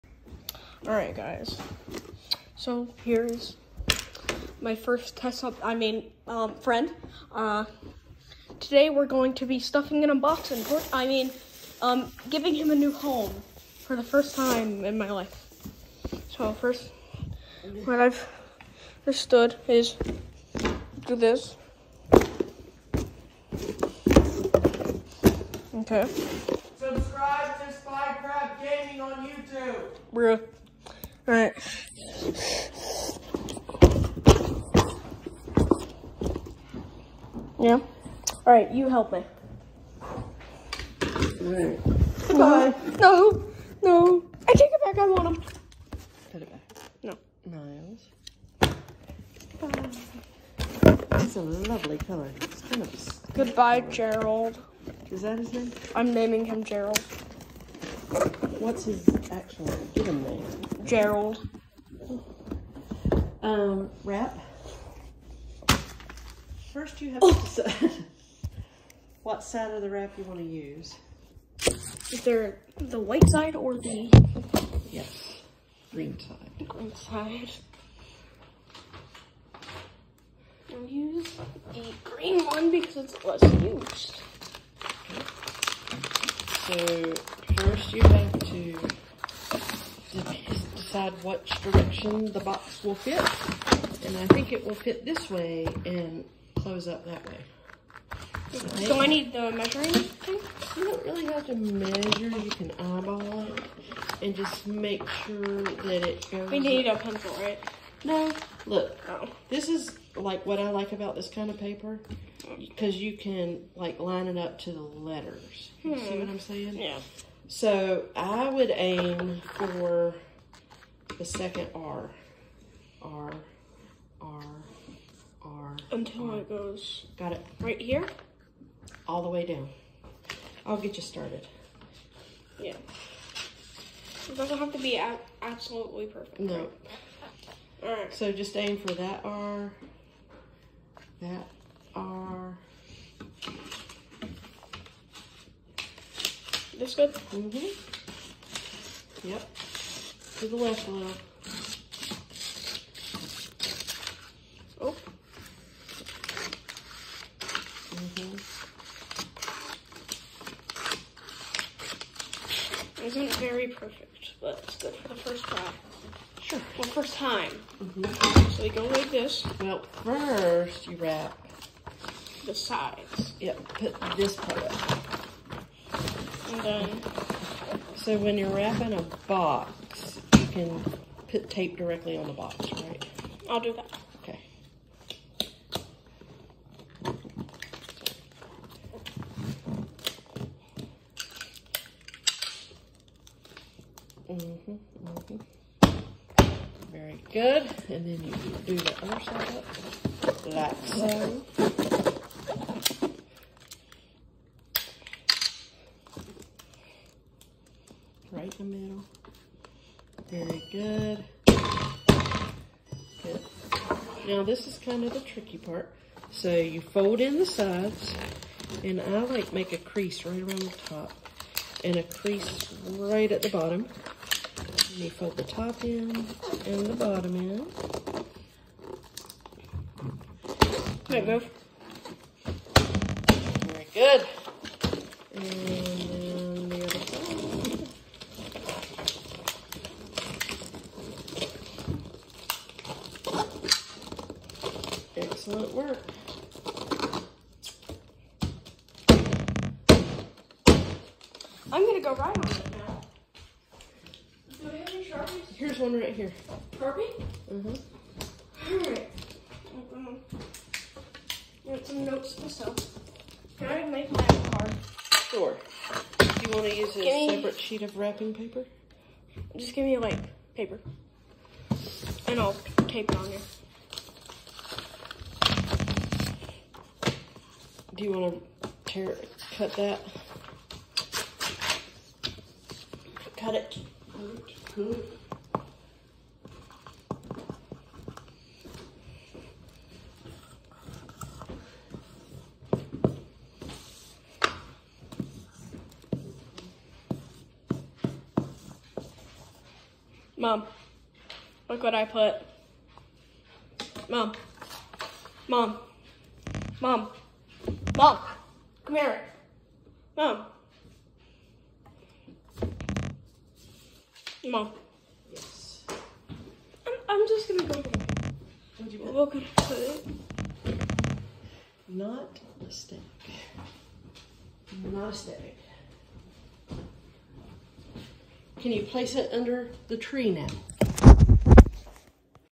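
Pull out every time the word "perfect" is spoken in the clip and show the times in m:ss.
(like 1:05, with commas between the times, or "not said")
2:16, 2:43.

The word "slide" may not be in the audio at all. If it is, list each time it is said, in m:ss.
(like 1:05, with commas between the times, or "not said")
not said.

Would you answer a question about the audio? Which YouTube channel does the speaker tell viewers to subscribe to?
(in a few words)
Spy Crab Gaming.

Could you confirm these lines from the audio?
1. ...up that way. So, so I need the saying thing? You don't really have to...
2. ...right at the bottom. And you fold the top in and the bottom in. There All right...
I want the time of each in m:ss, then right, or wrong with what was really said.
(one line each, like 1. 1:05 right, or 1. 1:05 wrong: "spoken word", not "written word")
1. 1:36 wrong: "measuring", not "saying"
2. 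3:42 right.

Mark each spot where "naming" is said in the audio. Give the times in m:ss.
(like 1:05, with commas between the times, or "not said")
0:56.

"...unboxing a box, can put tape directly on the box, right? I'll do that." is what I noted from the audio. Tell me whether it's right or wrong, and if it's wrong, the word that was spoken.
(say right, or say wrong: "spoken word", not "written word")
wrong: "wrapping", not "unboxing".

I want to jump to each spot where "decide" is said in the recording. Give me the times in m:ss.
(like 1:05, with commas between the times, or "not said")
1:07, 1:31.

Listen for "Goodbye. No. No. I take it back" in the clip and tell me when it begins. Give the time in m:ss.
0:42.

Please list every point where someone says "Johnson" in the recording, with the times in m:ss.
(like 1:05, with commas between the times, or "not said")
not said.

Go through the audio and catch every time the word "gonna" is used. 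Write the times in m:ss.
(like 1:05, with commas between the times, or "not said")
4:11, 5:17.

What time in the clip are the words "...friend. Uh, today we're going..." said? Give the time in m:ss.
0:06.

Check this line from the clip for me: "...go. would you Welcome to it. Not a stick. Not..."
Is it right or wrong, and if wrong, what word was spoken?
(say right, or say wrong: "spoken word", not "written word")
right.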